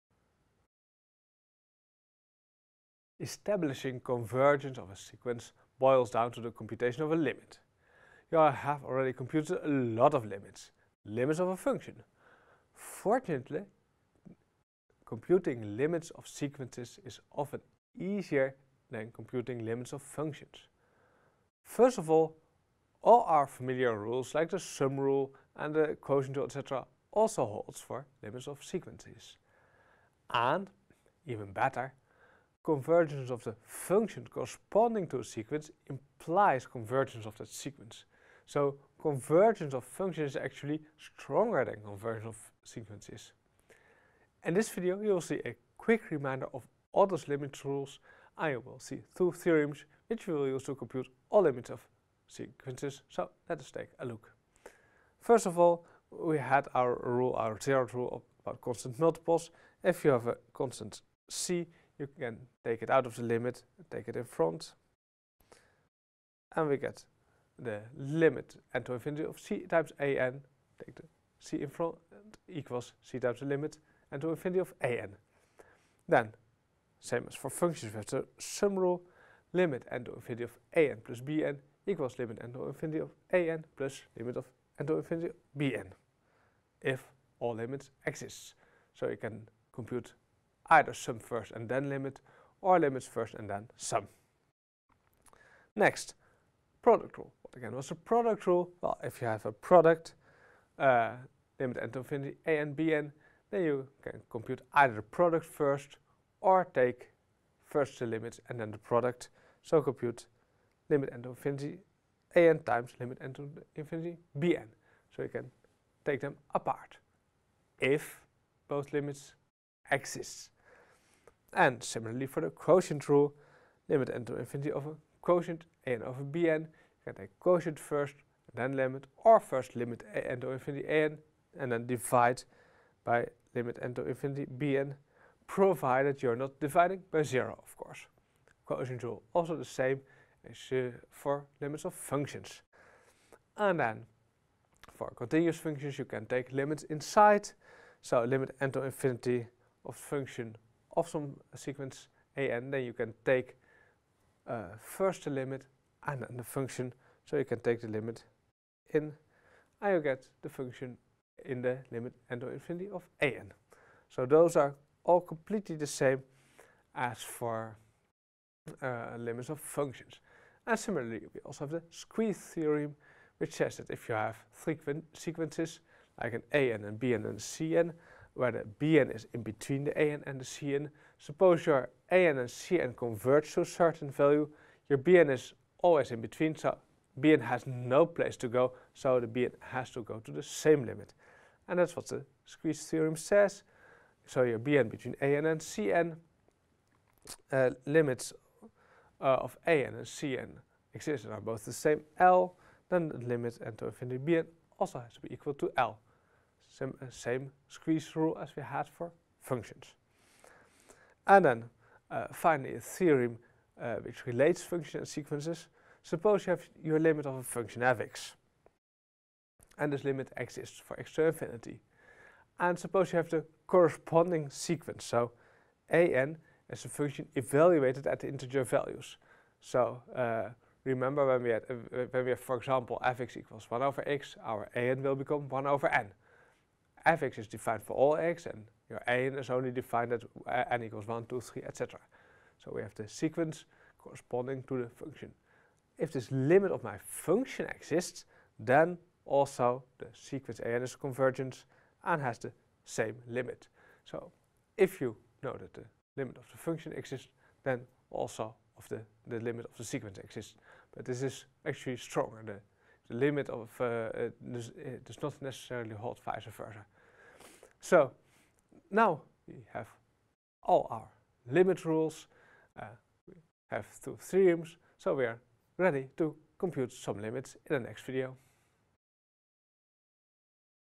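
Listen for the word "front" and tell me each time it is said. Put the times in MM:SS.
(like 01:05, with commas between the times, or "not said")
01:04, 01:11.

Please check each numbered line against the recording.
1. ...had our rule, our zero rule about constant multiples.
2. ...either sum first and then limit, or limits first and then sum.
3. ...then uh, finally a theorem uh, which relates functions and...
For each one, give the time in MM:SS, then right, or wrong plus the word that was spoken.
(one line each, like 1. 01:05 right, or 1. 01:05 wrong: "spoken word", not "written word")
1. 00:56 right
2. 01:30 right
3. 03:31 right.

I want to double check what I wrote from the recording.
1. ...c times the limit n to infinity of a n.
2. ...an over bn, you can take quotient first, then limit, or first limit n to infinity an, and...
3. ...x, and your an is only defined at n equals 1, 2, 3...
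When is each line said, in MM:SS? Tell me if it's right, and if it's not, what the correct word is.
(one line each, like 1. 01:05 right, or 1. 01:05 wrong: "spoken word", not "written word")
1. 01:13 right
2. 02:05 right
3. 03:58 right.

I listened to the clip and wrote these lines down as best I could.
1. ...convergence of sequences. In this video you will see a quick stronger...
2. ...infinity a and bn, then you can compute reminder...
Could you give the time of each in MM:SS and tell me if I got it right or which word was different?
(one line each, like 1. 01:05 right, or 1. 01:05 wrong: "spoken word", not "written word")
1. 00:41 wrong: "reminder", not "stronger"
2. 01:41 wrong: "either", not "reminder".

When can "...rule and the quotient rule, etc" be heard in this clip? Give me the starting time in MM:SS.
00:24.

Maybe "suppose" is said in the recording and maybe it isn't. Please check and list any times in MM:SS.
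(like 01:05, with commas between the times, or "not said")
03:01, 03:36, 03:42.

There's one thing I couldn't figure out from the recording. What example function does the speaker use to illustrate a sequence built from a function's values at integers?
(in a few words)
1 over x.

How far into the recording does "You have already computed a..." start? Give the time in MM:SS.
00:08.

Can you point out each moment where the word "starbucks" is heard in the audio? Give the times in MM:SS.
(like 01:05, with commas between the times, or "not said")
not said.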